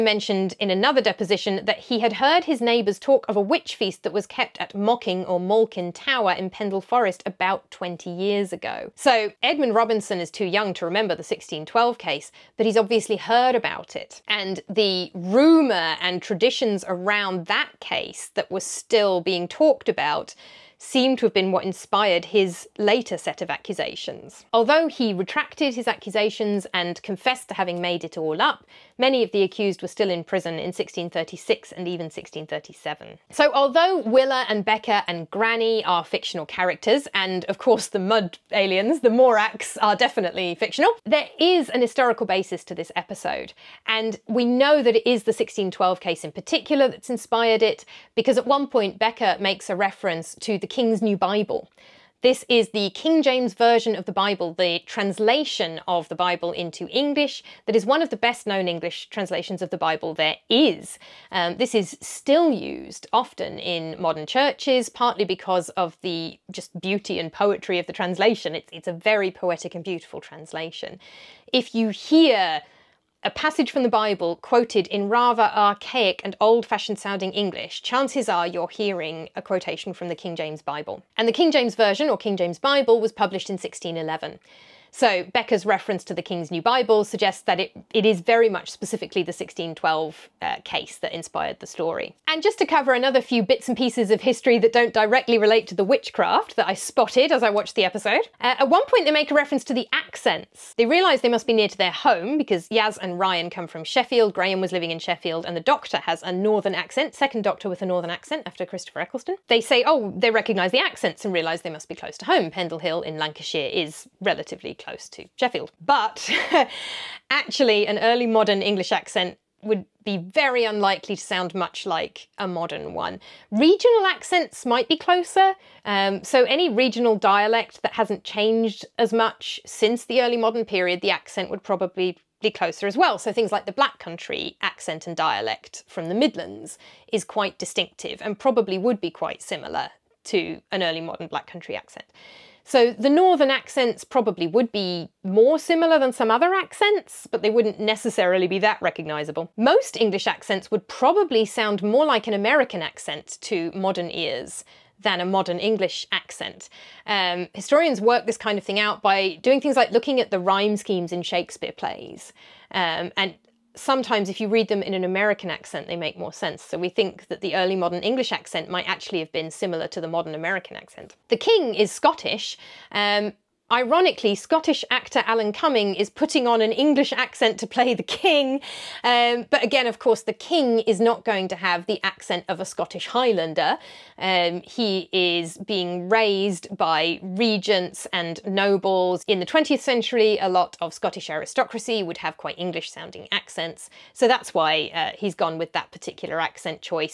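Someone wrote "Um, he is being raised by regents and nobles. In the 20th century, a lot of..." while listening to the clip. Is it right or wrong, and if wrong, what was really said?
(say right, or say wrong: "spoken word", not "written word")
right.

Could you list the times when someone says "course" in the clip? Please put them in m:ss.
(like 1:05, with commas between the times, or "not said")
0:37, 2:59.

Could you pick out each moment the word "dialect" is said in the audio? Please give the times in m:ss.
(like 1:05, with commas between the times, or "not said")
2:07, 2:15.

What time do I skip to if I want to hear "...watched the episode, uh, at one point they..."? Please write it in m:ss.
1:37.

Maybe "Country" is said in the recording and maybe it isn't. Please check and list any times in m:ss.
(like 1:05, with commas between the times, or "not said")
2:13, 2:21.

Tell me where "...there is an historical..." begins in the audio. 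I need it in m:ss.
0:41.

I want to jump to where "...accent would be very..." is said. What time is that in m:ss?
1:58.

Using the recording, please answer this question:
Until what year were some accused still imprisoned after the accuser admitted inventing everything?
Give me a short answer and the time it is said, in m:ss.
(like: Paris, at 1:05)
1637, at 0:32.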